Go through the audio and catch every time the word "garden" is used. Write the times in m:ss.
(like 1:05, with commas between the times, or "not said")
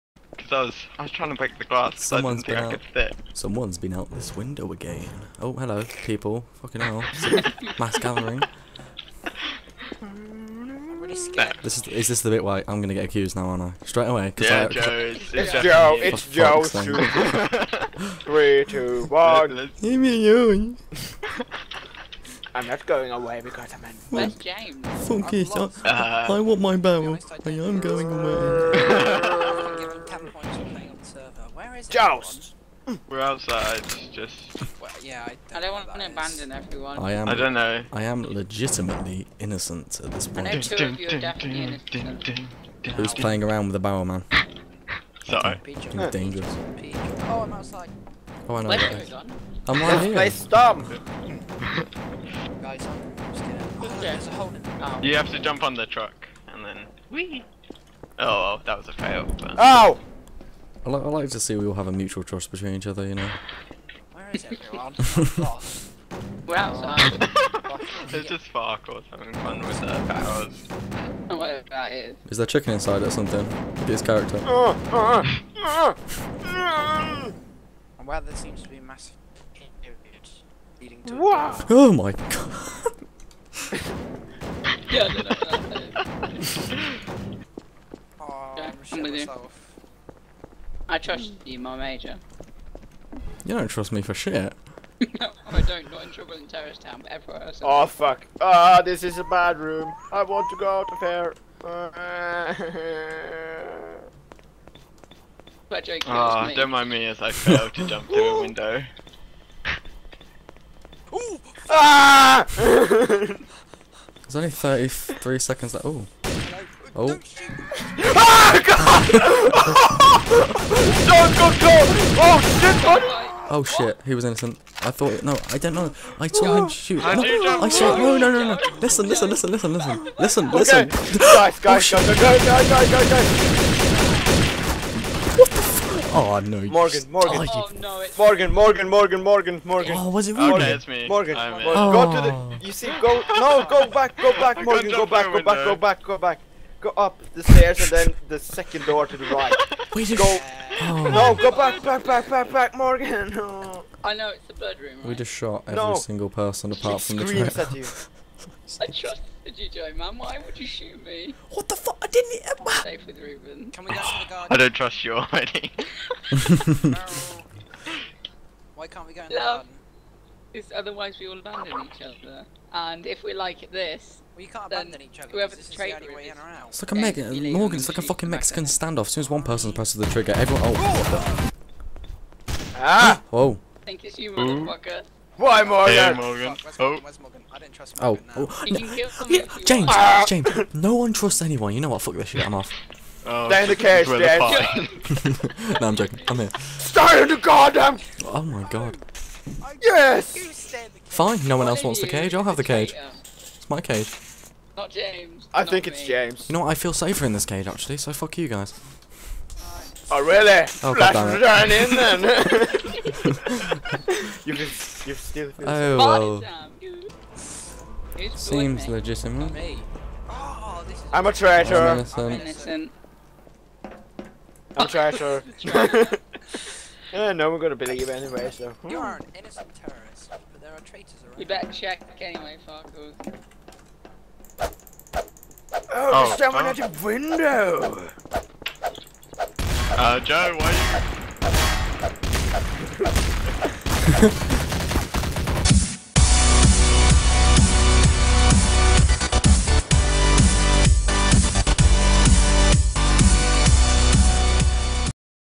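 2:44, 2:49.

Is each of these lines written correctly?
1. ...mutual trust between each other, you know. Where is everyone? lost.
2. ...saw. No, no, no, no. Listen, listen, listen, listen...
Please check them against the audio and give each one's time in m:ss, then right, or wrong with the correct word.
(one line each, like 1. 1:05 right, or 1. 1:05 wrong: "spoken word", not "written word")
1. 1:01 right
2. 2:07 right.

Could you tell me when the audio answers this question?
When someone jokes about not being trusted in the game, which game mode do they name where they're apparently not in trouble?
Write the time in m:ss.
1:36.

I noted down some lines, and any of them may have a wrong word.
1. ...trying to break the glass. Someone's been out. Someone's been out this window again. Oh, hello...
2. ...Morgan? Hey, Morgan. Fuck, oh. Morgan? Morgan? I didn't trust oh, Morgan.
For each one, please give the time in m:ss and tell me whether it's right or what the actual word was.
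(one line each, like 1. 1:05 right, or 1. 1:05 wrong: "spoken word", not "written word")
1. 0:01 right
2. 3:05 right.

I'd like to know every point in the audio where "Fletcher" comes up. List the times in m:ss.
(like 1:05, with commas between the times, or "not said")
1:45.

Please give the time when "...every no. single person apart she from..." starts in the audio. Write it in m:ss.
2:35.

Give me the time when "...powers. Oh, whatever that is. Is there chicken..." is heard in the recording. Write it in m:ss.
1:10.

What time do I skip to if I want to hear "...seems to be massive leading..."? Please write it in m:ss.
1:18.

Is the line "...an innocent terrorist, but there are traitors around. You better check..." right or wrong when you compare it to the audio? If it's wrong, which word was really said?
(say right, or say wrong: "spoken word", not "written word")
right.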